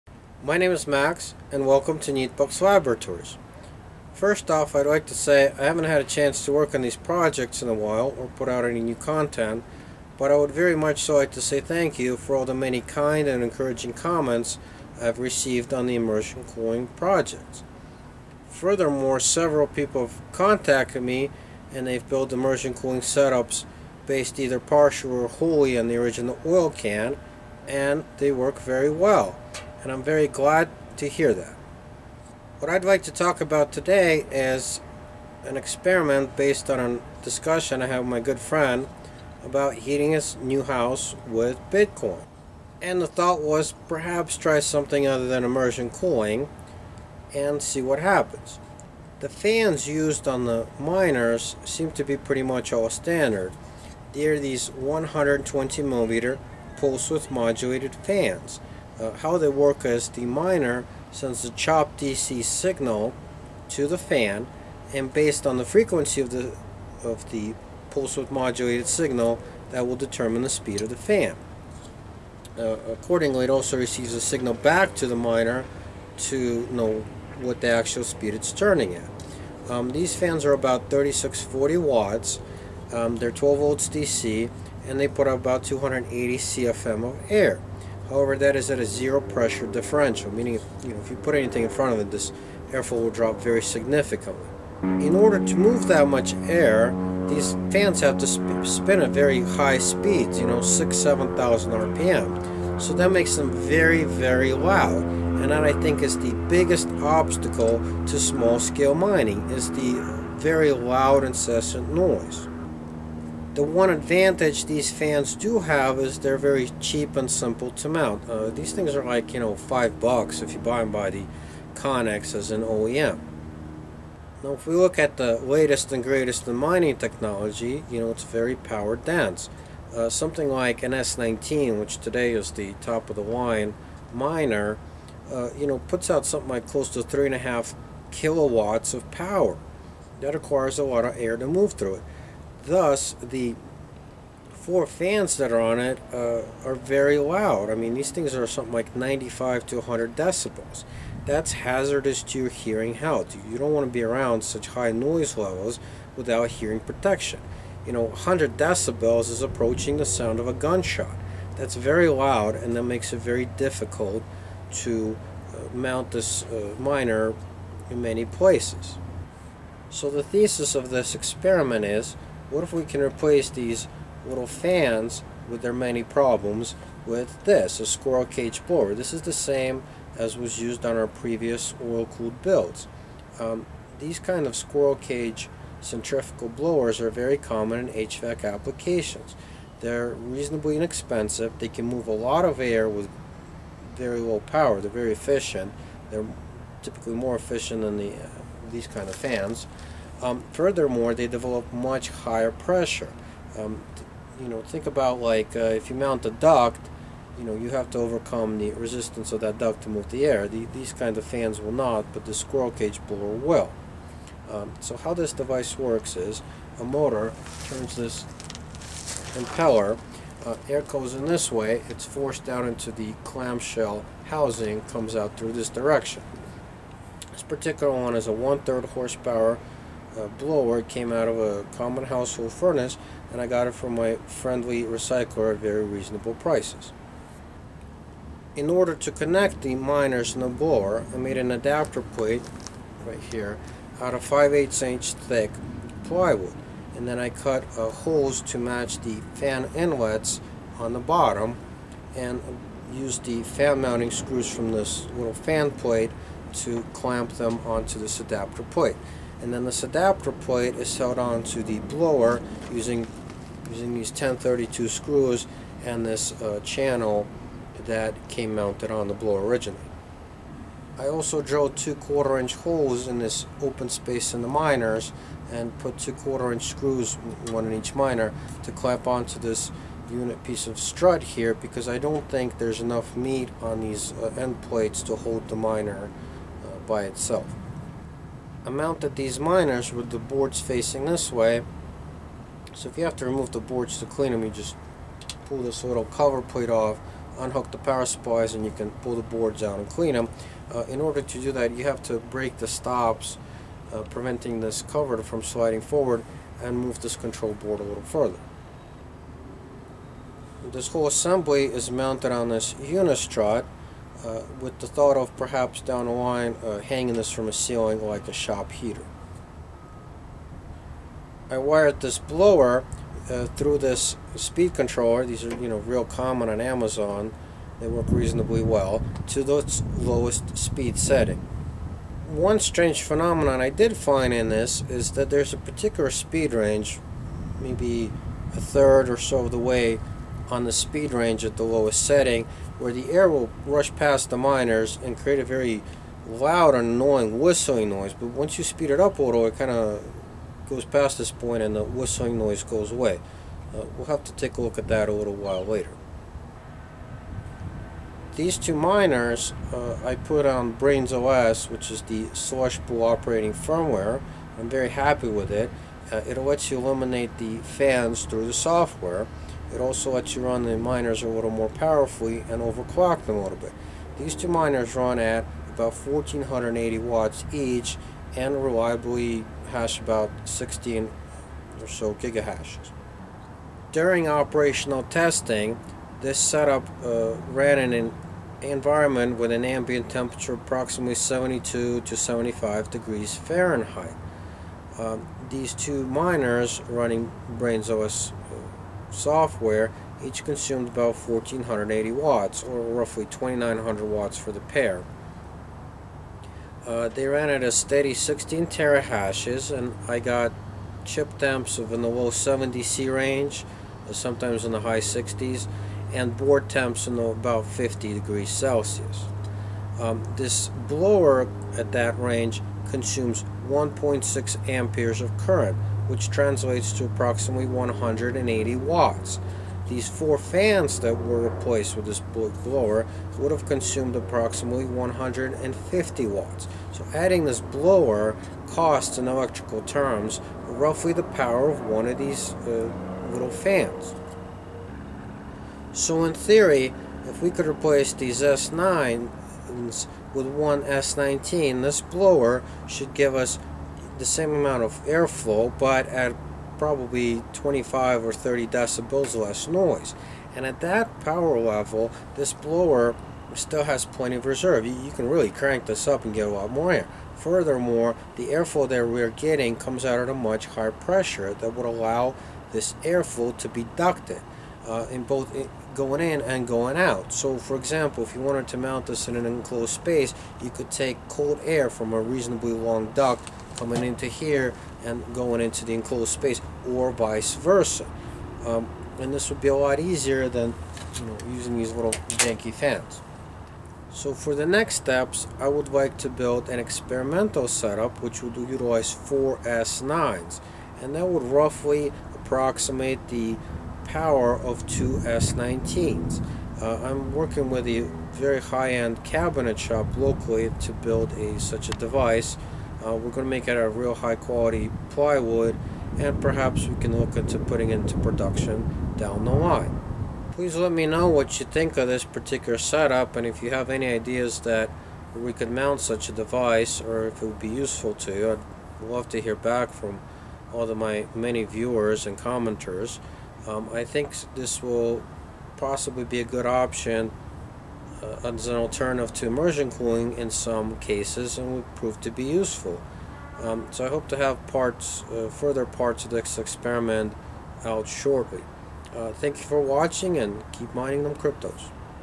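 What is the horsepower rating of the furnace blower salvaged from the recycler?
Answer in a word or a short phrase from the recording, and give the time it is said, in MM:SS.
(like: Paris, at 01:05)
one-third horsepower, at 03:48.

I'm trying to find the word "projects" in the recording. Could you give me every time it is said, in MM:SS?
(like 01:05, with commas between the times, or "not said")
00:06, 00:16.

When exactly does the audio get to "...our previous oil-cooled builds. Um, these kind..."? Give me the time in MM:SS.
03:00.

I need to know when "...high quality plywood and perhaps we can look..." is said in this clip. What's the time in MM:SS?
08:34.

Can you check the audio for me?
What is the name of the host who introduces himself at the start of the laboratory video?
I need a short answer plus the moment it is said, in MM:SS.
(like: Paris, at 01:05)
Max, at 00:00.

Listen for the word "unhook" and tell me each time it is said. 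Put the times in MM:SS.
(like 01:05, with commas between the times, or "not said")
04:57.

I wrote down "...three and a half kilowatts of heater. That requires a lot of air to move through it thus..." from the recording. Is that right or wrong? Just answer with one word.
wrong.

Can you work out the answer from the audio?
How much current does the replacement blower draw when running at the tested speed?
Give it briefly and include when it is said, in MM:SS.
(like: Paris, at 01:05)
1.6 amperes, at 07:03.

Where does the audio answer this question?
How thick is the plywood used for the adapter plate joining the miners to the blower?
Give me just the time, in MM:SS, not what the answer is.
04:04.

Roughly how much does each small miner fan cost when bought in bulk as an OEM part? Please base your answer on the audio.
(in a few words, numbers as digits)
5 dollars.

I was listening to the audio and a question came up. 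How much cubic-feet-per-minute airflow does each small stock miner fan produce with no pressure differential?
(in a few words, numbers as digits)
280 CFM.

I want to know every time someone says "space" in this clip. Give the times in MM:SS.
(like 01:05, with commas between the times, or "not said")
04:33, 07:59, 08:06.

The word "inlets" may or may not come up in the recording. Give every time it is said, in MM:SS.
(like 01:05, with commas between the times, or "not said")
04:09.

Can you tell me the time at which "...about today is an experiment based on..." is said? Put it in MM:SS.
00:33.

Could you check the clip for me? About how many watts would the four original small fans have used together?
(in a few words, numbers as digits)
150 watts.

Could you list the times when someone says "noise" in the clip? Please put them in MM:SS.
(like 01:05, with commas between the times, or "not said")
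01:51, 02:34, 05:47, 05:52, 07:39.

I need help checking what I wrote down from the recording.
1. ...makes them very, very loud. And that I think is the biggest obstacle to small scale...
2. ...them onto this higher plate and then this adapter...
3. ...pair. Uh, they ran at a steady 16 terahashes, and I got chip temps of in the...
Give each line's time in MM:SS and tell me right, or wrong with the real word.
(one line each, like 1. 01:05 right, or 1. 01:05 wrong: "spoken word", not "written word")
1. 01:43 right
2. 04:17 wrong: "adapter", not "higher"
3. 06:44 right.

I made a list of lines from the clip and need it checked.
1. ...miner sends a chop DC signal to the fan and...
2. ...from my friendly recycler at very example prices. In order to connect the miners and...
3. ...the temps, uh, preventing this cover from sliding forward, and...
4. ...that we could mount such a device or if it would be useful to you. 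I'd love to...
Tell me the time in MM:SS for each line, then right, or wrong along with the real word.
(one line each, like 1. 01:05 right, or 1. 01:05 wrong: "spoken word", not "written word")
1. 01:00 right
2. 03:53 wrong: "reasonable", not "example"
3. 05:02 wrong: "stops", not "temps"
4. 08:44 right.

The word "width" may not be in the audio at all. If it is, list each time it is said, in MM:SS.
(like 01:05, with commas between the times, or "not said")
00:57, 01:08.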